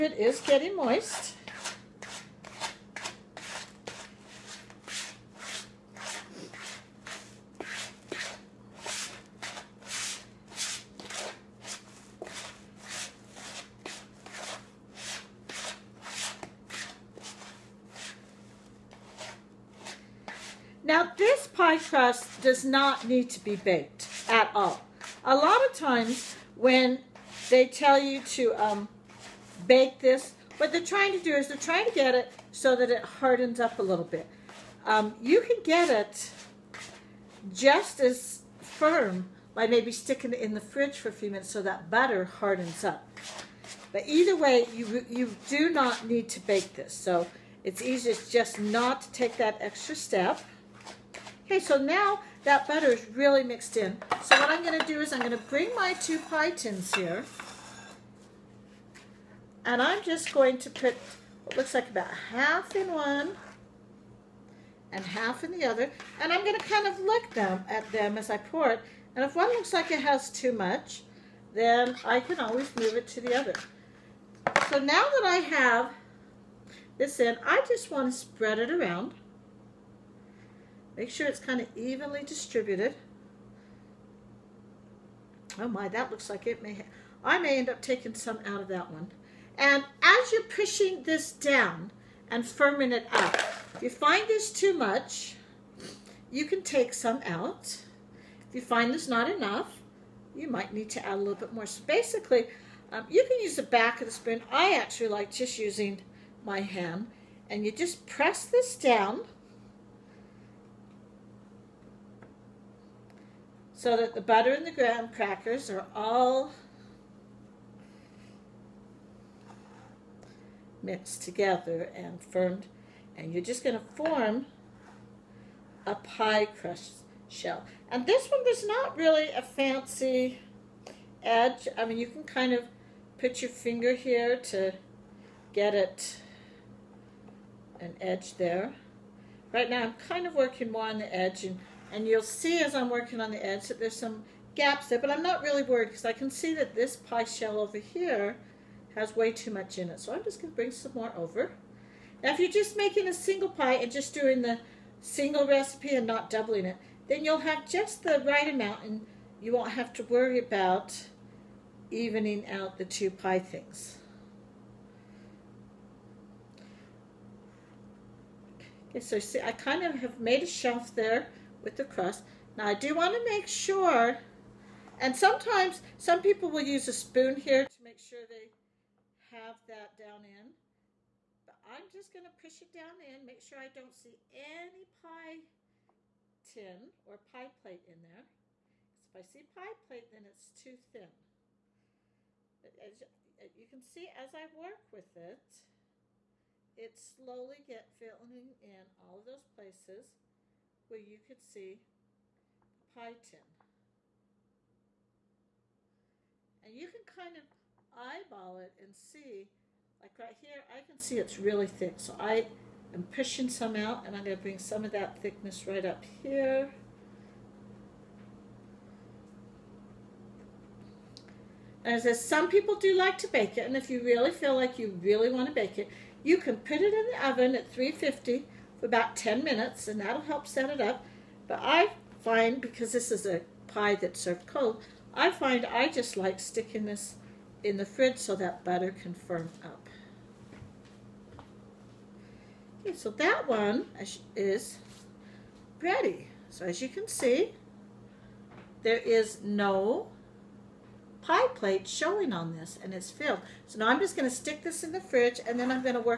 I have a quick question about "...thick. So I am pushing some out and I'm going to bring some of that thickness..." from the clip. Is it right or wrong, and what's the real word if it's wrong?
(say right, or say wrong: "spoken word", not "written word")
right.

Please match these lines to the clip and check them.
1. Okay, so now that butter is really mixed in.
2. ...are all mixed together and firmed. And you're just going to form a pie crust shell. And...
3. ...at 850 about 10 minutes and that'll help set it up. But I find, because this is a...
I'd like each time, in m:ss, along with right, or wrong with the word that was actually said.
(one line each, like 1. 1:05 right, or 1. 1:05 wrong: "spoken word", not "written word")
1. 0:51 right
2. 1:55 right
3. 3:47 wrong: "350", not "850".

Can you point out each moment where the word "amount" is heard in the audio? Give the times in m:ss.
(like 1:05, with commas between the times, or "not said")
2:38.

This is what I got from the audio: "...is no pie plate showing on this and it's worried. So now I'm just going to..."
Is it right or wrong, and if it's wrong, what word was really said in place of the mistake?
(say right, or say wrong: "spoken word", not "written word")
wrong: "filled", not "worried".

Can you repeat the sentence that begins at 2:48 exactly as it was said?
Okay, so see, I kind of have made a shelf there with the crust.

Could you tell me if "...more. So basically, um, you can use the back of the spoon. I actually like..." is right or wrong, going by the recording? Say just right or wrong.
right.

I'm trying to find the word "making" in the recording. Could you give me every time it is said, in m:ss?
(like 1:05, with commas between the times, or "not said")
2:32.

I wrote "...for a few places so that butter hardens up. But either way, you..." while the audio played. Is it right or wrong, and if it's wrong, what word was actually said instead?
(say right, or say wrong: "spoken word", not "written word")
wrong: "minutes", not "places".